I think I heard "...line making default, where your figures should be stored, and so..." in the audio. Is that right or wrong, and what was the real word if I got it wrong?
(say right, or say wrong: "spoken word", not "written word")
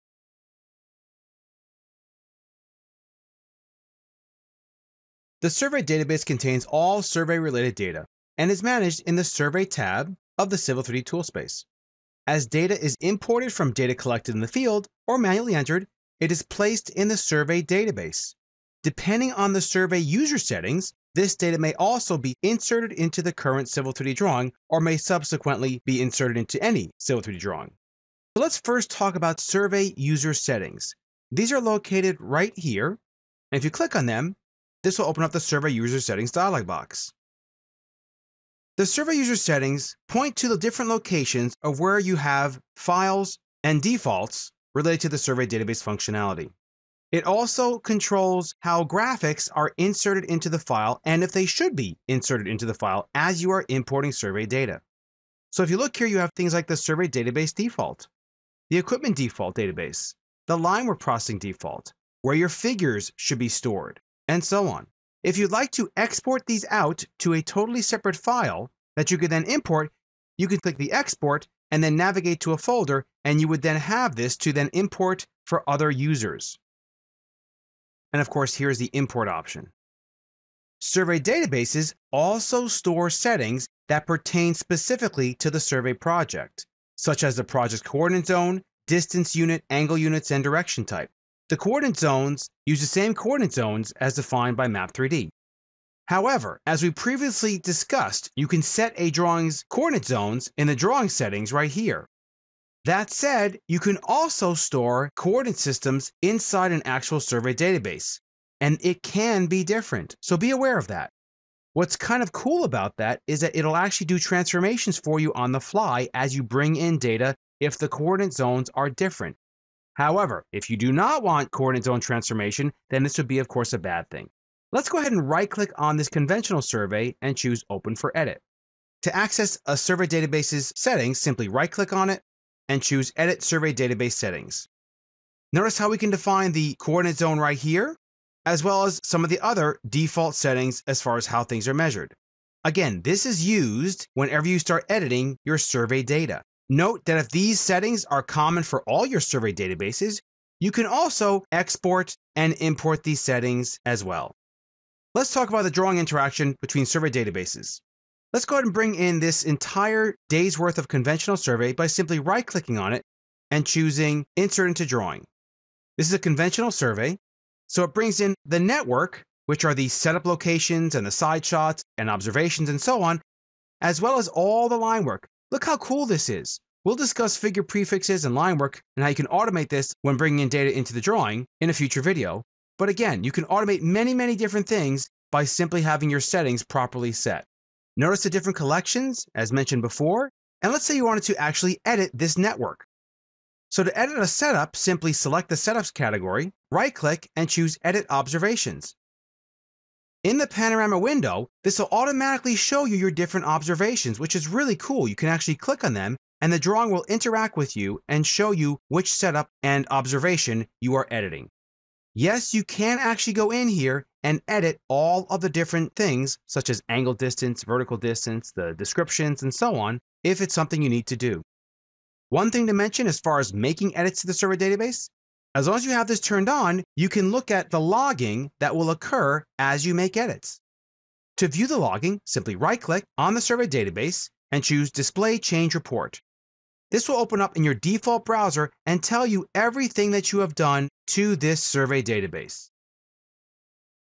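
wrong: "processing", not "making".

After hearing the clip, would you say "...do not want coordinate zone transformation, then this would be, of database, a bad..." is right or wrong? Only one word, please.
wrong.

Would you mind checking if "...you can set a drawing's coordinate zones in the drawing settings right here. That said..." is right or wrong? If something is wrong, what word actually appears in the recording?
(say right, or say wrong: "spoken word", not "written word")
right.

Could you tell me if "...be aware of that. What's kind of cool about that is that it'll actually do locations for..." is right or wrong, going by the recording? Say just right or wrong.
wrong.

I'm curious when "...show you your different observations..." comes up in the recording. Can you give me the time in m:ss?
3:22.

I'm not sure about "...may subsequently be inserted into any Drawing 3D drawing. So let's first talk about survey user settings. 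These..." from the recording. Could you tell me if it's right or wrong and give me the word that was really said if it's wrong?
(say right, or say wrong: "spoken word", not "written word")
wrong: "Civil", not "Drawing".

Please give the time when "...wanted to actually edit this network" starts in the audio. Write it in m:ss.
3:11.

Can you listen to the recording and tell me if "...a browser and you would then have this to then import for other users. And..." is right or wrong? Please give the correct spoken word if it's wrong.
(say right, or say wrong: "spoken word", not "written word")
wrong: "folder", not "browser".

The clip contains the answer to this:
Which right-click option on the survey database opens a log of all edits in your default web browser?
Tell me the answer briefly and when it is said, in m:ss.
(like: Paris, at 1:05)
Display Change Report, at 3:54.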